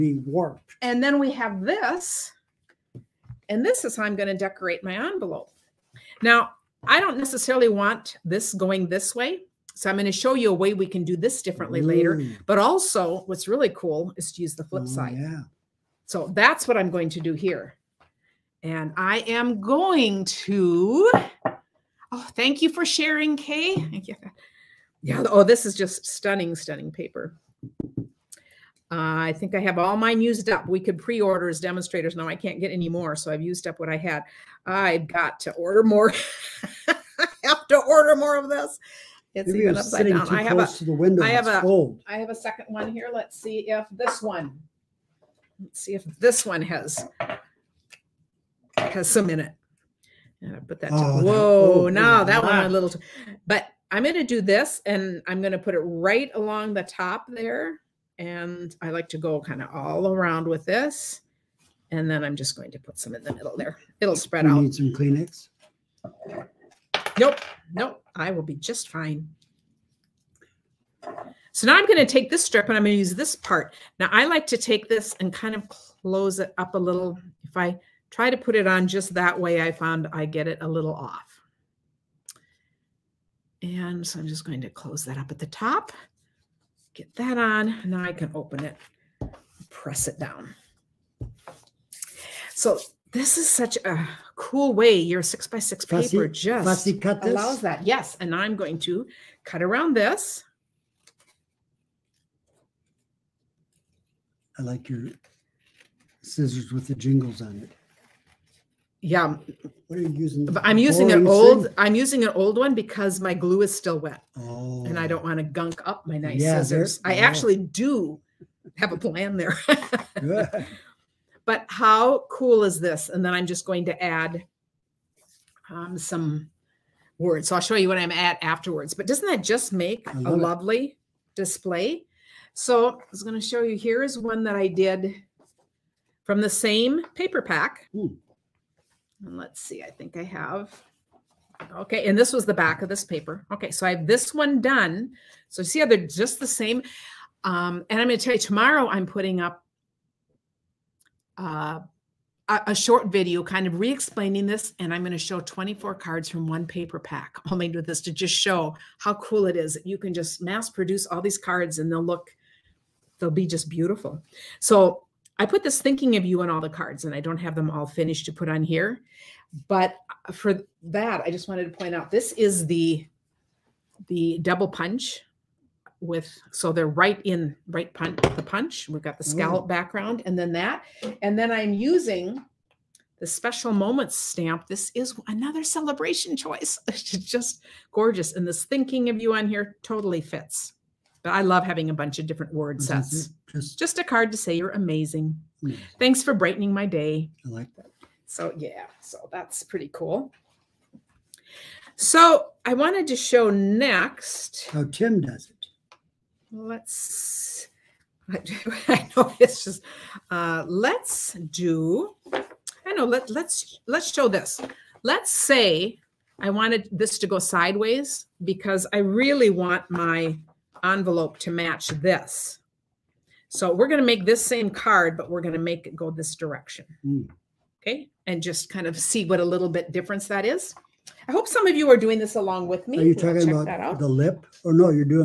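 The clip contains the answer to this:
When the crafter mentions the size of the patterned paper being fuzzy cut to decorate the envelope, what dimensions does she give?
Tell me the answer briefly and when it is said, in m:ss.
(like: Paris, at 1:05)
6 by 6, at 1:35.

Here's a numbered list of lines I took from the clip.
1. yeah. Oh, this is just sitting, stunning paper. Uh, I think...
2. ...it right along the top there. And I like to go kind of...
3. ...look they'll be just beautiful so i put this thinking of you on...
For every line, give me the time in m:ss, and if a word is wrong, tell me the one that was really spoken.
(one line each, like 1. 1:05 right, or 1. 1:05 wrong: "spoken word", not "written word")
1. 0:25 wrong: "stunning", not "sitting"
2. 0:55 right
3. 2:42 right.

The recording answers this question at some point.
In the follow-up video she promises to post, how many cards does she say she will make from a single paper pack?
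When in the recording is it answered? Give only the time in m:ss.
2:35.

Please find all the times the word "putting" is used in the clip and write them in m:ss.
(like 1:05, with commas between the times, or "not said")
2:29.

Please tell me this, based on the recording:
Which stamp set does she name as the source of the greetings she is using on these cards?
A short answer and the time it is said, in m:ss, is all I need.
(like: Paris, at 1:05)
Special Moments, at 3:03.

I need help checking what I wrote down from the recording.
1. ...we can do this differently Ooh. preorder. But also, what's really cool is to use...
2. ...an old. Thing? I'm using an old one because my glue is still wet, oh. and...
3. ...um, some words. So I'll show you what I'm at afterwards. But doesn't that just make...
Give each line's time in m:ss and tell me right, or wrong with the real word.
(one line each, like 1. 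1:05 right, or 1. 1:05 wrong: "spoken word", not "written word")
1. 0:10 wrong: "later", not "preorder"
2. 1:51 right
3. 2:05 right.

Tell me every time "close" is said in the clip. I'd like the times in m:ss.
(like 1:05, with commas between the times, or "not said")
0:40, 1:15, 1:24.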